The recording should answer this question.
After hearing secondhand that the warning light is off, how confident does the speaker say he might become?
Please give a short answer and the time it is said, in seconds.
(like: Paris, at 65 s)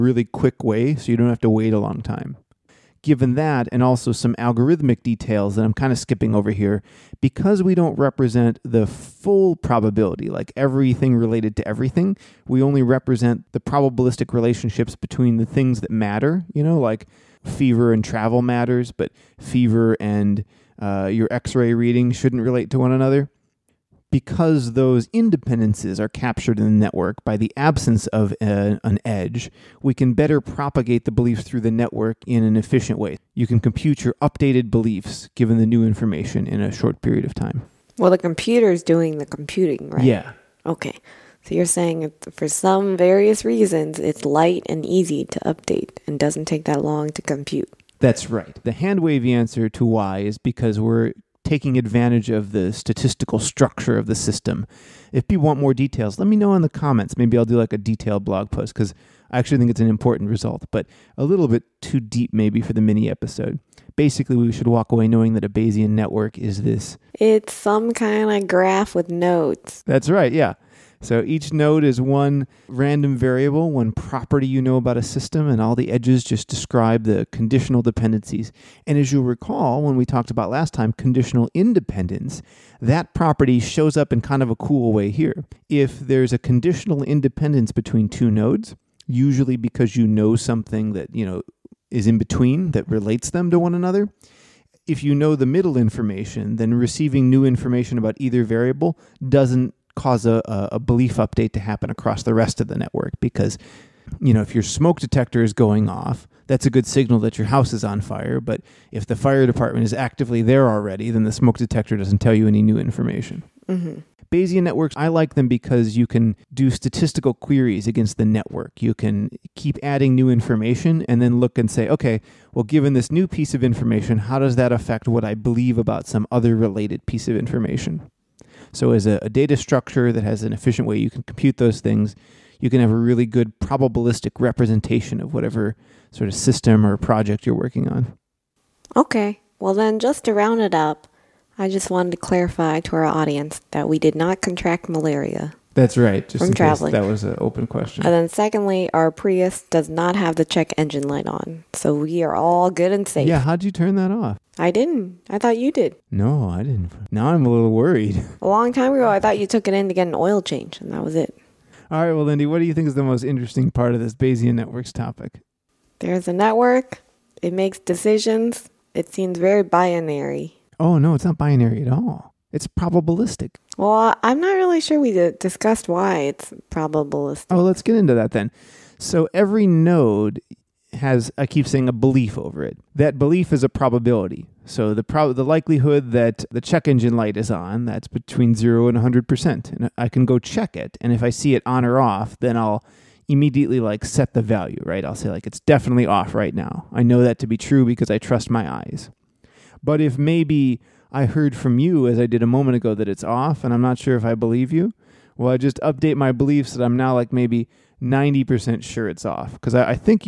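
90%, at 208 s.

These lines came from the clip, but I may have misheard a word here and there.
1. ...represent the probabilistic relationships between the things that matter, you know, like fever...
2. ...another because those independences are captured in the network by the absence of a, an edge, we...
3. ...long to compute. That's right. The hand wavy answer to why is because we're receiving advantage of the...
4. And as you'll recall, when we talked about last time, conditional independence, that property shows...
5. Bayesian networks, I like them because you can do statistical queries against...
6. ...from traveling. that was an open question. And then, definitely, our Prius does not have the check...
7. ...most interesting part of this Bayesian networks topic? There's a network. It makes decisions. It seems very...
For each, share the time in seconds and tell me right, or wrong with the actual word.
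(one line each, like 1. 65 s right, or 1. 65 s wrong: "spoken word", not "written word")
1. 12 s right
2. 22 s right
3. 46 s wrong: "taking", not "receiving"
4. 78 s right
5. 114 s right
6. 146 s wrong: "secondly", not "definitely"
7. 163 s right.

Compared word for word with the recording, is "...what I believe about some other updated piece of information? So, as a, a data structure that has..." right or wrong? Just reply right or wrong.
wrong.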